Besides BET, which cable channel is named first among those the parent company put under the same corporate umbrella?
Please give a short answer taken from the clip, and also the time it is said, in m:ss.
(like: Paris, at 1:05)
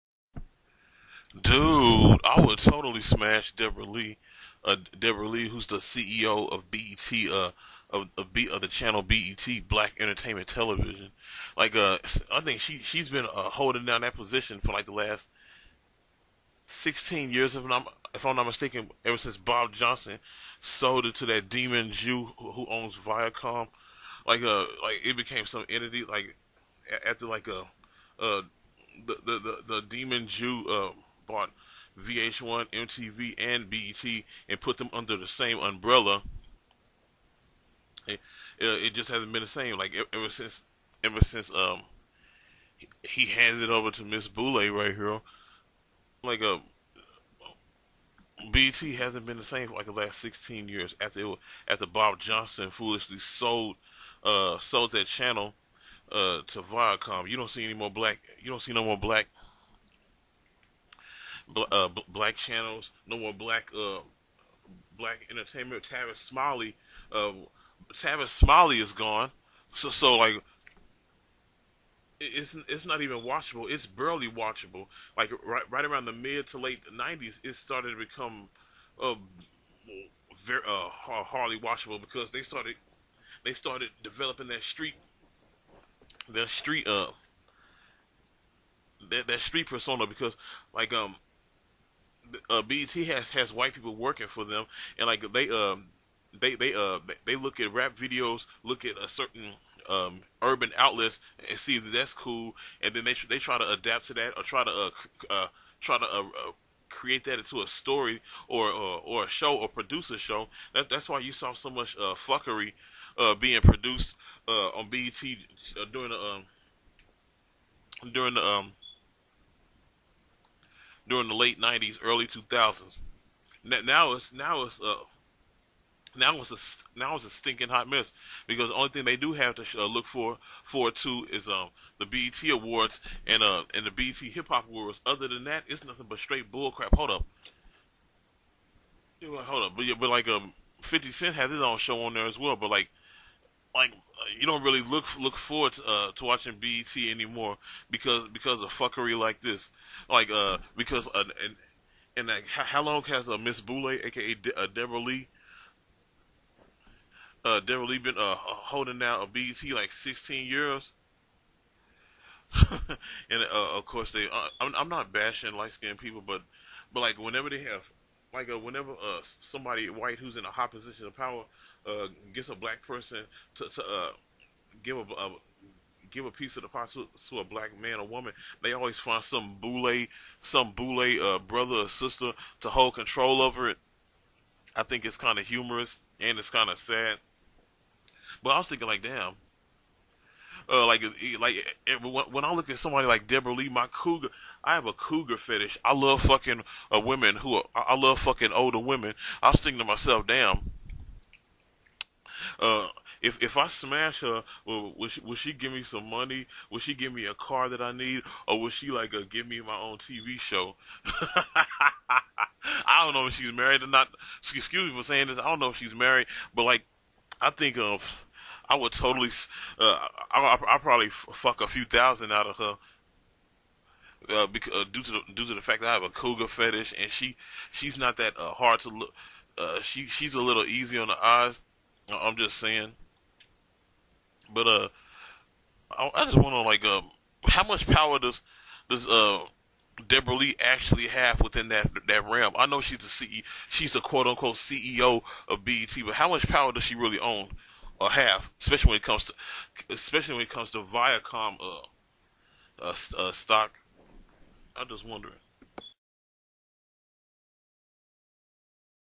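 VH1, at 0:31.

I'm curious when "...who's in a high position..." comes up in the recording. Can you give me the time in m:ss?
2:50.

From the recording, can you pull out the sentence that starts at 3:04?
I think it's kind of humorous and it's kind of sad.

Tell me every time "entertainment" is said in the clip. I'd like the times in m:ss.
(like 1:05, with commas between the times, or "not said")
0:09, 1:05.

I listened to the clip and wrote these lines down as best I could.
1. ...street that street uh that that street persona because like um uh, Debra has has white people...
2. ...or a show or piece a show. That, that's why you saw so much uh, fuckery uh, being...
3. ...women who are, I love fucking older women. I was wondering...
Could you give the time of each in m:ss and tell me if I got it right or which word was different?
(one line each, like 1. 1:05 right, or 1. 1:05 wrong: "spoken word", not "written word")
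1. 1:24 wrong: "BET", not "Debra"
2. 1:49 wrong: "produce", not "piece"
3. 3:16 wrong: "thinking", not "wondering".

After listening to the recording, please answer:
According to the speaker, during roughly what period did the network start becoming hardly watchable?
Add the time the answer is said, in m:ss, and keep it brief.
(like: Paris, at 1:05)
mid to late '90s, at 1:16.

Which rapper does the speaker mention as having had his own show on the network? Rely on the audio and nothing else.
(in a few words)
50 Cent.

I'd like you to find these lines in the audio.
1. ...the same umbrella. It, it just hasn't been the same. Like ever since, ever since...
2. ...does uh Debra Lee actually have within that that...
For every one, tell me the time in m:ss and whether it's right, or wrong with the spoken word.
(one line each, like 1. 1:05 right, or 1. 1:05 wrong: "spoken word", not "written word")
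1. 0:35 right
2. 3:58 right.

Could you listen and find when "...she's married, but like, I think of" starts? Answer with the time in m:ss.
3:35.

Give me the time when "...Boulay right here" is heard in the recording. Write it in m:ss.
0:44.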